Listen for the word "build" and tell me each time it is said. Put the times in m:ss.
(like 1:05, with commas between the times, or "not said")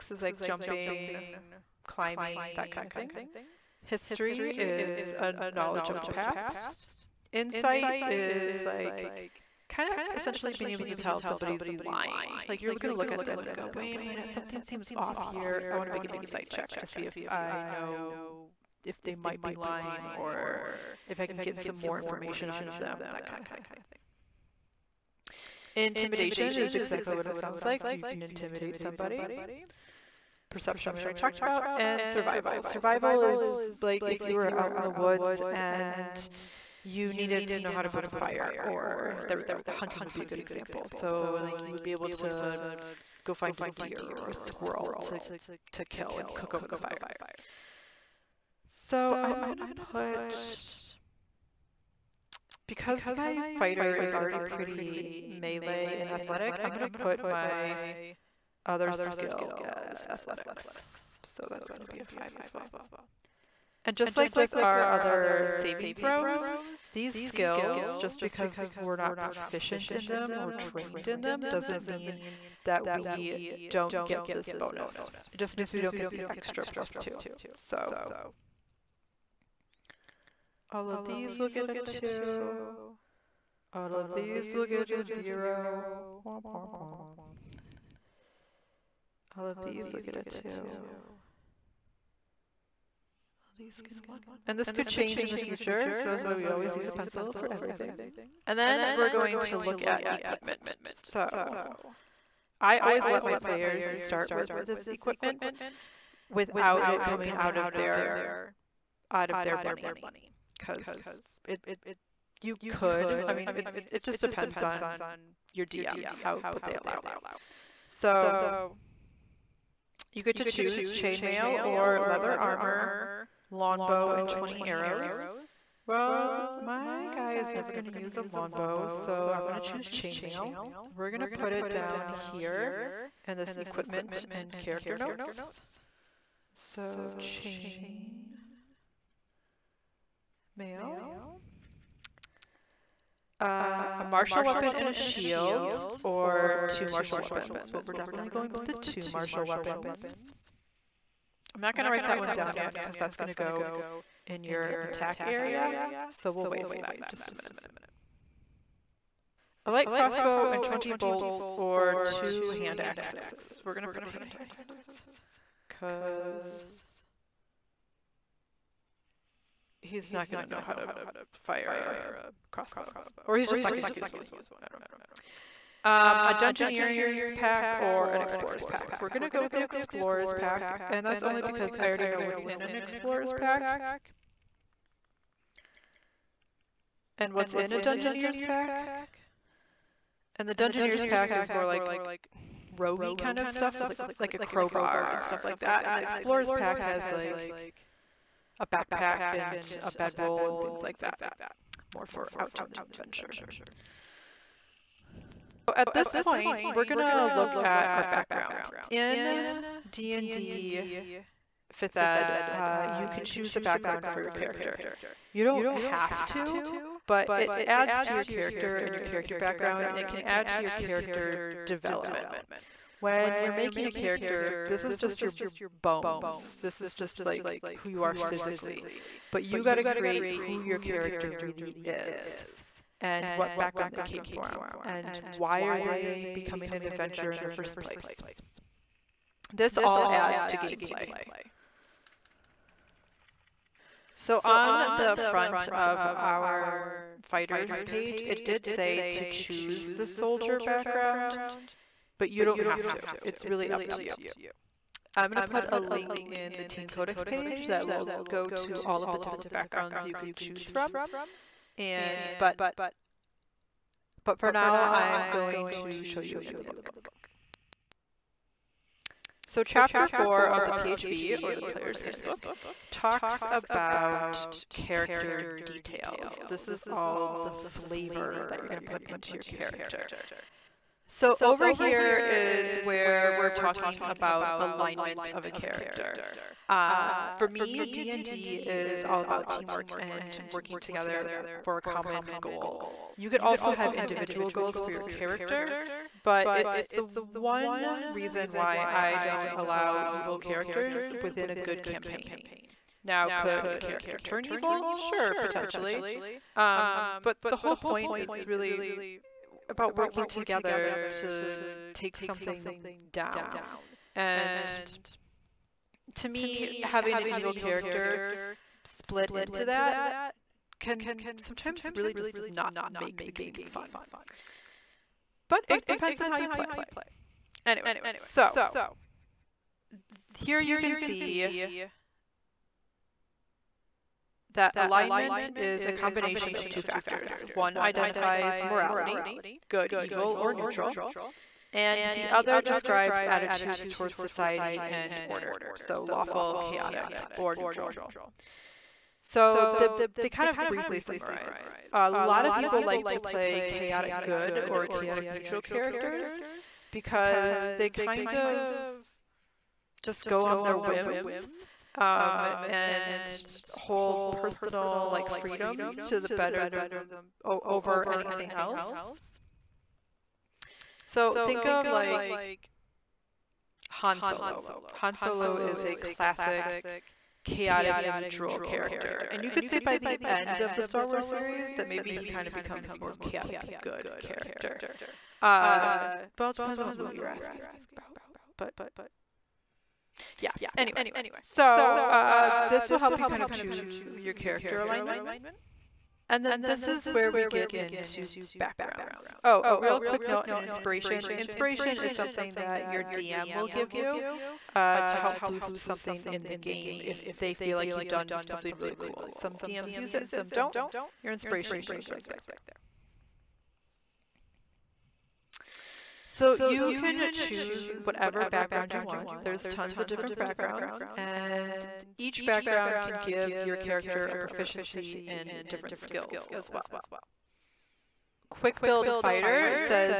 0:37, 7:08.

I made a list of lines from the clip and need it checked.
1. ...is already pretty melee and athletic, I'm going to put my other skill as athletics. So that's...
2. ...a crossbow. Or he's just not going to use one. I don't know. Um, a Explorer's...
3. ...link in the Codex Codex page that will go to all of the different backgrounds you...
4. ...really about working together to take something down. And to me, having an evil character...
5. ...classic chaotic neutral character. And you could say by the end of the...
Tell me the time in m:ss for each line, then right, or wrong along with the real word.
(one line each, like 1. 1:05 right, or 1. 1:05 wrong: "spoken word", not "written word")
1. 0:53 right
2. 2:51 wrong: "Dungeoneer", not "Explorer"
3. 4:15 wrong: "Teen", not "Codex"
4. 5:08 right
5. 6:15 right.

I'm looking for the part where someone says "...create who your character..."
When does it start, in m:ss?
3:49.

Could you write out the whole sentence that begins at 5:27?
Anyway, so here you can see that alignment is a combination of two factors.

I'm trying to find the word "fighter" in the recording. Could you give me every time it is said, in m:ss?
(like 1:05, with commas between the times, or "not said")
0:53, 4:07, 7:09.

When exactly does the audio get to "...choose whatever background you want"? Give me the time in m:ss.
6:57.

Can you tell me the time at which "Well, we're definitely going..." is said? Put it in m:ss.
2:27.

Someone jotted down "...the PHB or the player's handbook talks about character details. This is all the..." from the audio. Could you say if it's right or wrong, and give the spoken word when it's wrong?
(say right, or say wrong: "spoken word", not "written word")
right.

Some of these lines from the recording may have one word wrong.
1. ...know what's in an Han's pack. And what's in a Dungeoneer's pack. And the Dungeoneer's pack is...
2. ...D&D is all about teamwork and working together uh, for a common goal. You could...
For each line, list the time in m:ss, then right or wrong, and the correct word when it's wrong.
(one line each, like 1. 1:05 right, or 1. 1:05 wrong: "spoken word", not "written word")
1. 3:02 wrong: "Explorer", not "Han"
2. 4:47 right.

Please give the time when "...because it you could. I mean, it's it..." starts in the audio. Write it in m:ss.
1:50.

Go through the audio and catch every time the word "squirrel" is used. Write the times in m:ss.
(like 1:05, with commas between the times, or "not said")
0:44.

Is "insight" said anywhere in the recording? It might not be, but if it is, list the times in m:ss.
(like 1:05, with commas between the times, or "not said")
0:07, 0:16.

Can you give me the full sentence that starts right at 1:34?
And this could change in the future, so that's why we always use a pencil for everything.